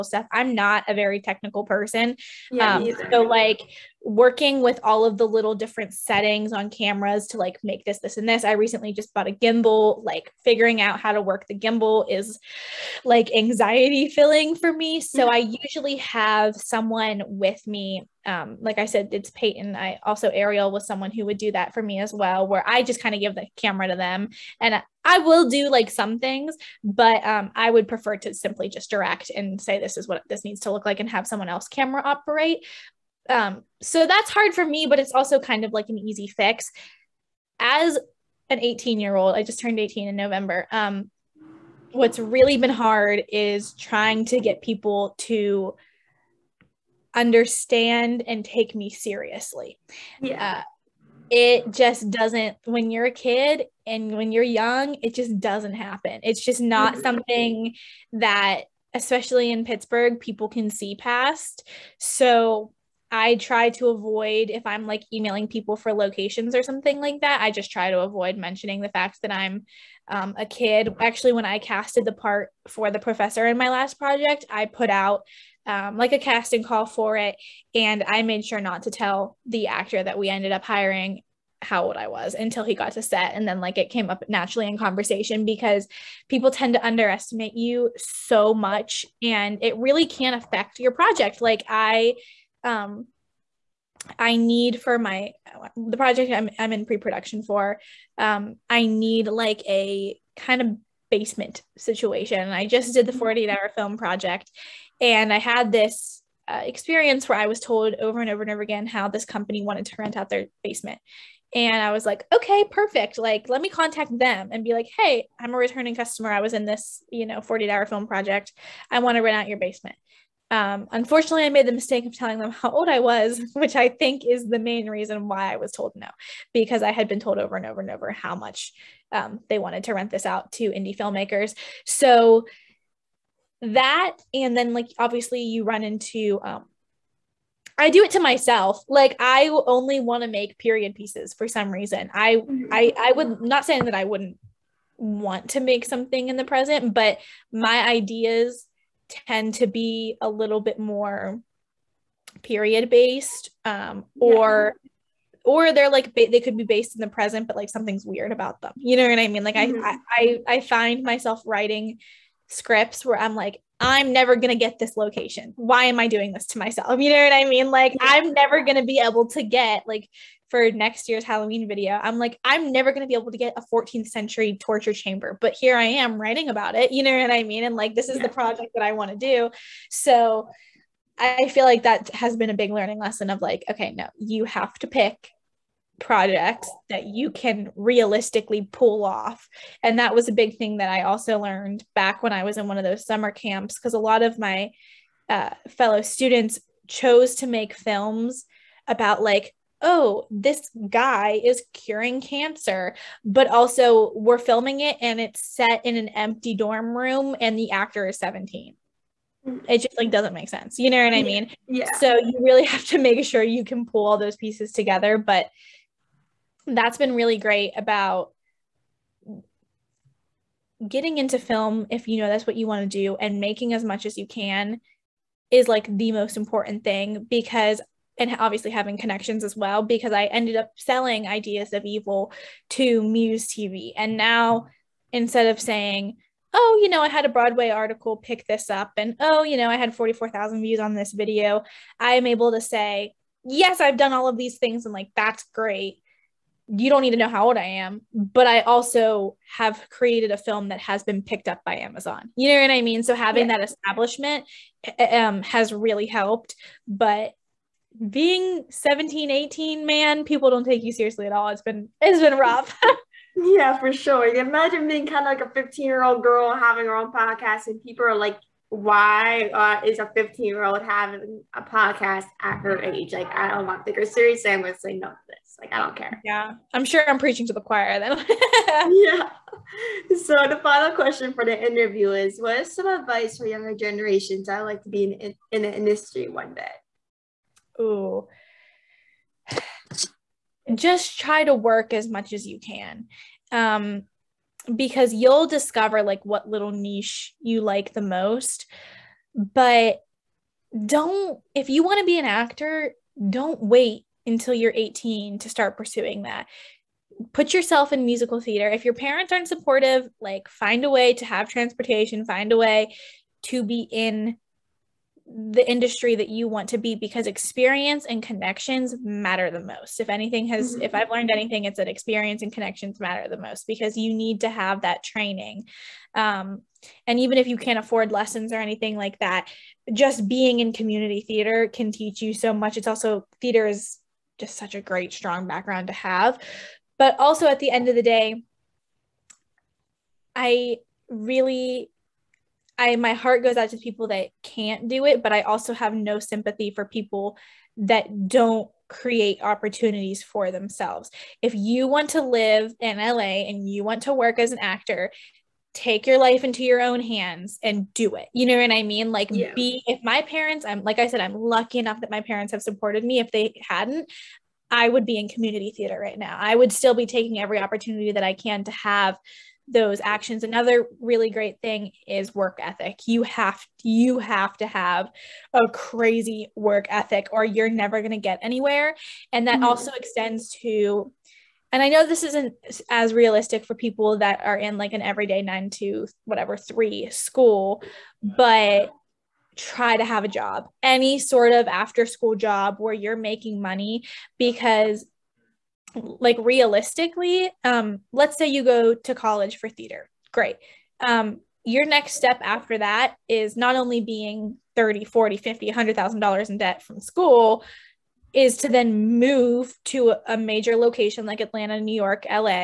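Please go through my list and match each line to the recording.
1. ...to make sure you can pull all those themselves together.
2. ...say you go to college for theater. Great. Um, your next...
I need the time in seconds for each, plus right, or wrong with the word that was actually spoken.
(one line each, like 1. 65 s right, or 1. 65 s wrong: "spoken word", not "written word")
1. 212 s wrong: "pieces", not "themselves"
2. 398 s right.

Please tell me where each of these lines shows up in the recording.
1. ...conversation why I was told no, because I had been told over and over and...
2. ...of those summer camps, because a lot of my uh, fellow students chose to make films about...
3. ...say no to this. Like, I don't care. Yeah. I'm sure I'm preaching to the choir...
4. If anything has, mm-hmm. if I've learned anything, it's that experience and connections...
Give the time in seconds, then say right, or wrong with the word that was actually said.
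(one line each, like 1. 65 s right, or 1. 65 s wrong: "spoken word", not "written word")
1. 124 s wrong: "reason", not "conversation"
2. 192 s right
3. 274 s right
4. 319 s right.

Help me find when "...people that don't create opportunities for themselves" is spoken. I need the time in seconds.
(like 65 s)
346 s.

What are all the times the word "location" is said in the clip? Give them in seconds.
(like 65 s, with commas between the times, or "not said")
65 s, 164 s, 410 s.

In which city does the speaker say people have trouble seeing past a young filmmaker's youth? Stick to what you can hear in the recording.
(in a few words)
Pittsburgh.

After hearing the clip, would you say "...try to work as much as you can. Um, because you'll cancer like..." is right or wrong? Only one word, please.
wrong.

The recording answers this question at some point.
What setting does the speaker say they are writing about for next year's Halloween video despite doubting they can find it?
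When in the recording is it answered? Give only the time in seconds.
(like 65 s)
173 s.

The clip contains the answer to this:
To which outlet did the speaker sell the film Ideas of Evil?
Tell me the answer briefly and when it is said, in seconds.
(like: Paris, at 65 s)
Muse TV, at 233 s.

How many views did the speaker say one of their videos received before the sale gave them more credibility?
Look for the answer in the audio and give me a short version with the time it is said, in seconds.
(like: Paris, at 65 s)
44,000, at 239 s.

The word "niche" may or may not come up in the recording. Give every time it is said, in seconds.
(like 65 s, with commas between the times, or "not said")
296 s.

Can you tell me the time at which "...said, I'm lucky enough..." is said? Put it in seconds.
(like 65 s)
361 s.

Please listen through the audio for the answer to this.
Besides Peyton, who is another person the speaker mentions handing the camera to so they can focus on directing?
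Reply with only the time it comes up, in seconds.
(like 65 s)
20 s.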